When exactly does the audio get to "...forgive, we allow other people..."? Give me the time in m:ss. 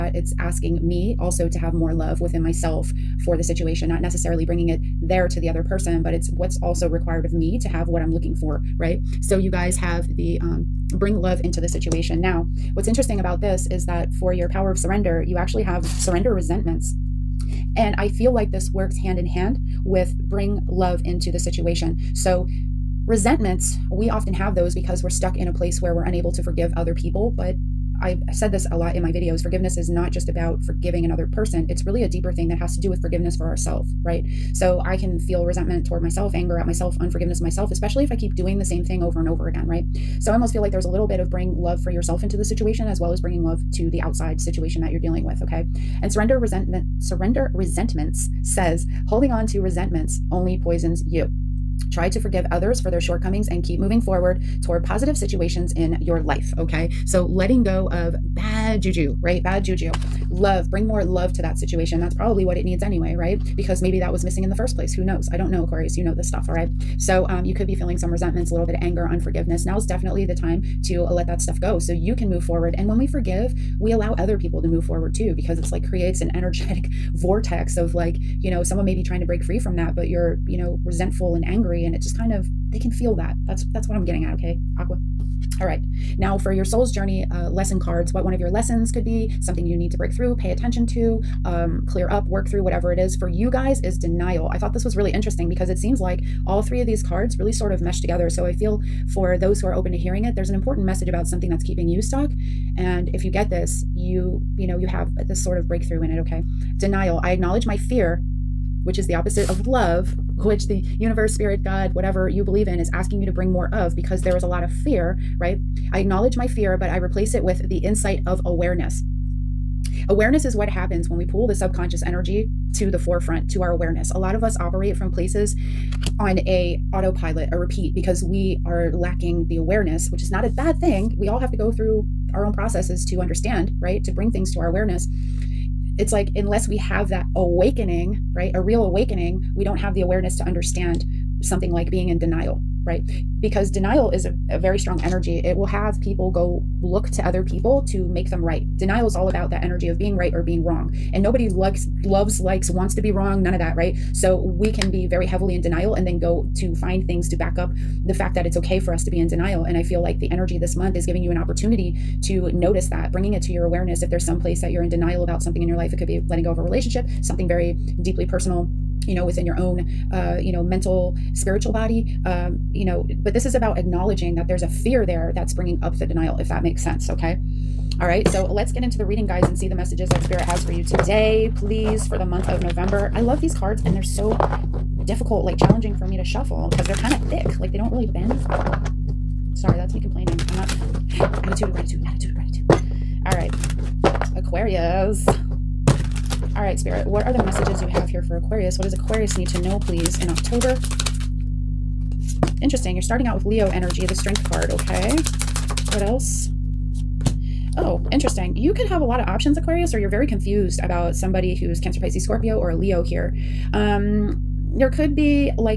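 1:13.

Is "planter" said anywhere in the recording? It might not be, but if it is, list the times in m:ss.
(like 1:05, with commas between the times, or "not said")
not said.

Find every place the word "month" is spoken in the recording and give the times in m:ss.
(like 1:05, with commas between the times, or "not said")
2:40, 3:02.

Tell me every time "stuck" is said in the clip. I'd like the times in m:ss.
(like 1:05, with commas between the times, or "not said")
0:25, 1:42.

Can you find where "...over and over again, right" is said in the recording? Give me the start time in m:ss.
0:39.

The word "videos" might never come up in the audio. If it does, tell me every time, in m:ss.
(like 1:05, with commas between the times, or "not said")
0:29.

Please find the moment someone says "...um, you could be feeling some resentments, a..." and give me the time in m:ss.
1:07.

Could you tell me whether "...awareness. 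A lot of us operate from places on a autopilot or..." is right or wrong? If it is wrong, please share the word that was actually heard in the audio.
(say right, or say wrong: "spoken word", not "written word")
right.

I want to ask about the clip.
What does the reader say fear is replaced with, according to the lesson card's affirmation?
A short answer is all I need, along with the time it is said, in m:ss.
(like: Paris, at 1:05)
The insight of awareness, at 1:57.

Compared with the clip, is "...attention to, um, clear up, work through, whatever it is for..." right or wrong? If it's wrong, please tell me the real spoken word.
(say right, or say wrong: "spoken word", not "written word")
right.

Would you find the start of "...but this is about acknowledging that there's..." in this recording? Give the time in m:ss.
2:53.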